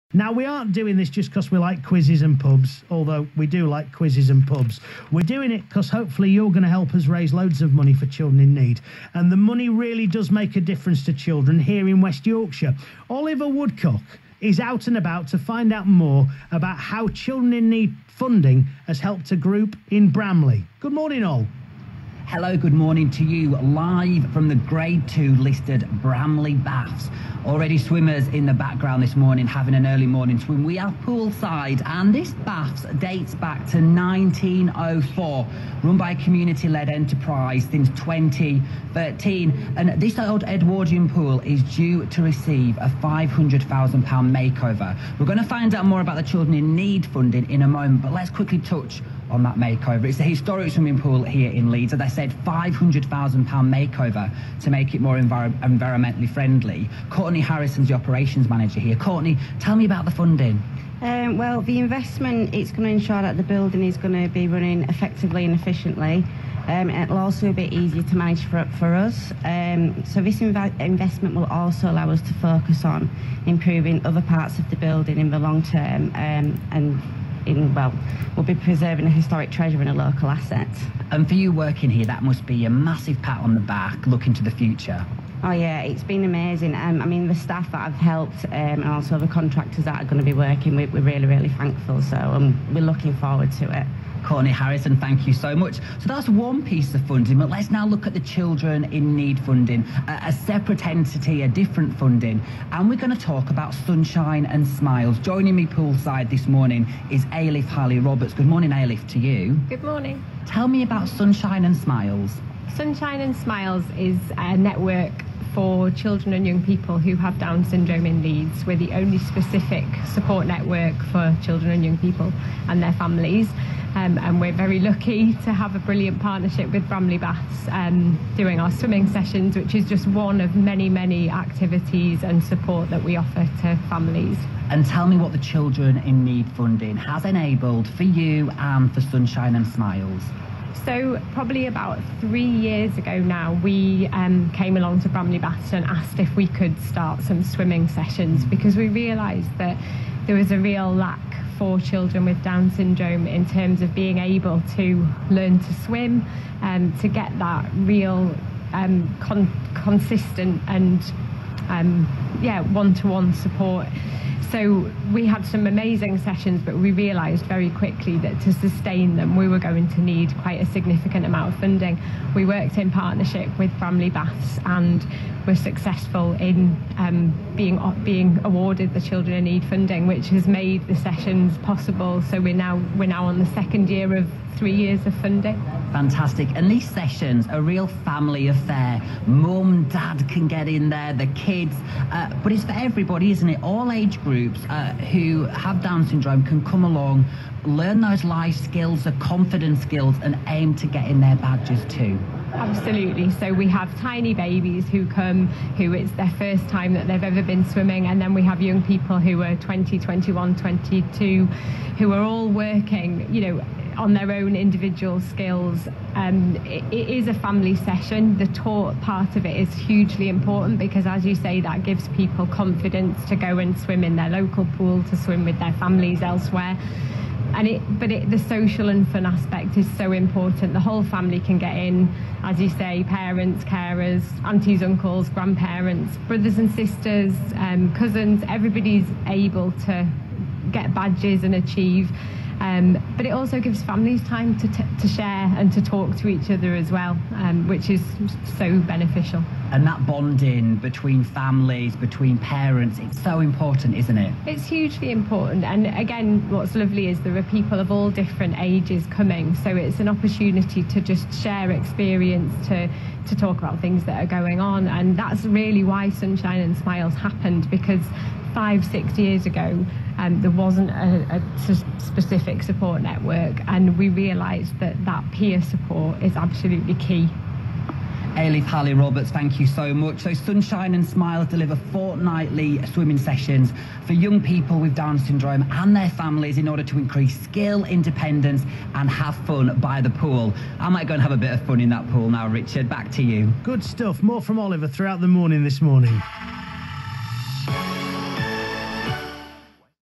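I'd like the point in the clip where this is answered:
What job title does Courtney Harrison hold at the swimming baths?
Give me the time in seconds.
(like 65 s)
57 s.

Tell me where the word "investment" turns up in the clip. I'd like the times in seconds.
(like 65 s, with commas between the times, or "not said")
61 s, 70 s.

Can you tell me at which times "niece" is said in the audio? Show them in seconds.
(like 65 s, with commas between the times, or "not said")
not said.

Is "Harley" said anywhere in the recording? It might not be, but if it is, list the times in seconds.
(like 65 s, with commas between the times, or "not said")
107 s, 278 s.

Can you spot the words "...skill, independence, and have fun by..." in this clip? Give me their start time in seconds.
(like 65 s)
287 s.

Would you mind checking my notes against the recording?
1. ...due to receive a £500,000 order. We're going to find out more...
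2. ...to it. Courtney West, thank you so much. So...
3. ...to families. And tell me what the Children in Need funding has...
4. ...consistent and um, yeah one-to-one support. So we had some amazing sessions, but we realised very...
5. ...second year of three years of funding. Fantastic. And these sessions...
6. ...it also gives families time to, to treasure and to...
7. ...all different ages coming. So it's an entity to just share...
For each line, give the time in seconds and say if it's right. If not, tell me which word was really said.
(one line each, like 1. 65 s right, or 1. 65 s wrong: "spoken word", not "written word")
1. 41 s wrong: "makeover", not "order"
2. 93 s wrong: "Harrison", not "West"
3. 133 s right
4. 159 s right
5. 183 s right
6. 243 s wrong: "share", not "treasure"
7. 257 s wrong: "opportunity", not "entity".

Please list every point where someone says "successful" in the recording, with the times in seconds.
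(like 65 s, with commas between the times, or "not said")
175 s.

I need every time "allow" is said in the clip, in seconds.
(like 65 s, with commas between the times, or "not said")
71 s.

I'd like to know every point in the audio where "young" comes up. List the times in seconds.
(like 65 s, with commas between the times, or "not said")
116 s, 121 s, 208 s, 284 s.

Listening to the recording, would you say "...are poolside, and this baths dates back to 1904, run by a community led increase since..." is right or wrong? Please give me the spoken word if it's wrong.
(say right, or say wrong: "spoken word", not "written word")
wrong: "enterprise", not "increase".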